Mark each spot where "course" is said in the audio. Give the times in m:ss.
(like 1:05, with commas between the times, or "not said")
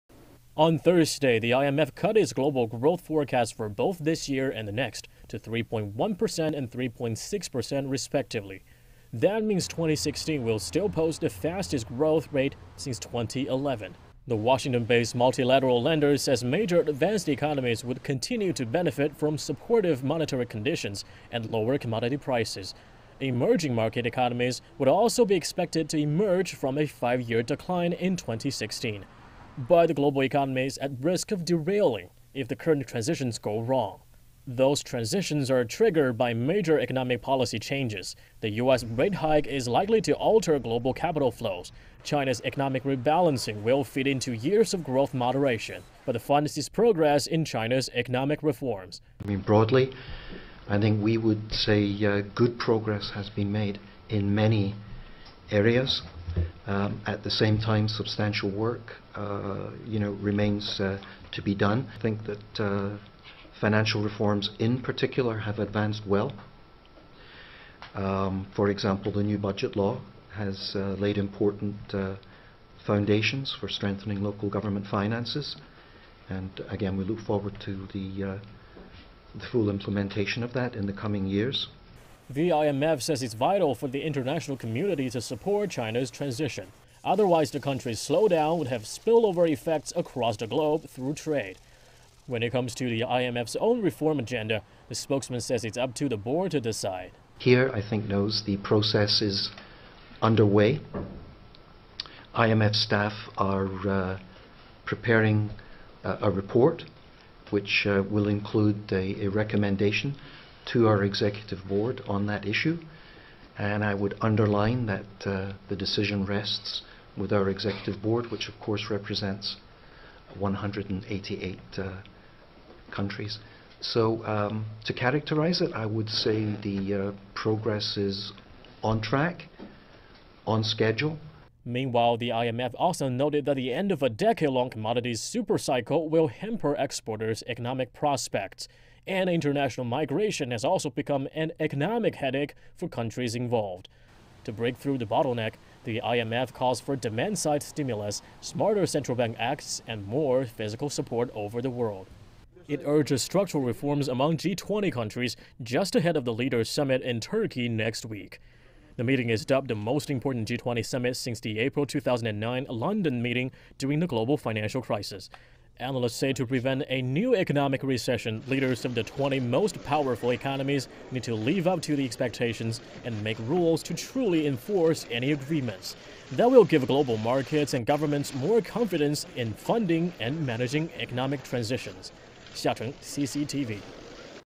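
1:58.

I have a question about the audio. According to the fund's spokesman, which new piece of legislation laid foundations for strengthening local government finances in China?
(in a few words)
the new budget law.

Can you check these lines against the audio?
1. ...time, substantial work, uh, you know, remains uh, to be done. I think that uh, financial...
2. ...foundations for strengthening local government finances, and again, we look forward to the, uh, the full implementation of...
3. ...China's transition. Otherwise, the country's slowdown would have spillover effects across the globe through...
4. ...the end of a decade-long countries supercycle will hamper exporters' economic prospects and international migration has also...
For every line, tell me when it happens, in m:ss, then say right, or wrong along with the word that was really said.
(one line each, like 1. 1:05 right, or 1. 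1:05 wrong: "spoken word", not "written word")
1. 0:57 right
2. 1:12 right
3. 1:25 right
4. 2:13 wrong: "commodities", not "countries".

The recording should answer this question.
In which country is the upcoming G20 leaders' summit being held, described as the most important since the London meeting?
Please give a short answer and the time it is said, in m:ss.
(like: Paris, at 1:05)
Turkey, at 2:37.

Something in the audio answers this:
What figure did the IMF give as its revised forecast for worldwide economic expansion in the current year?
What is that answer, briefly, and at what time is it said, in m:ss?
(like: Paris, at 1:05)
3.1%, at 0:05.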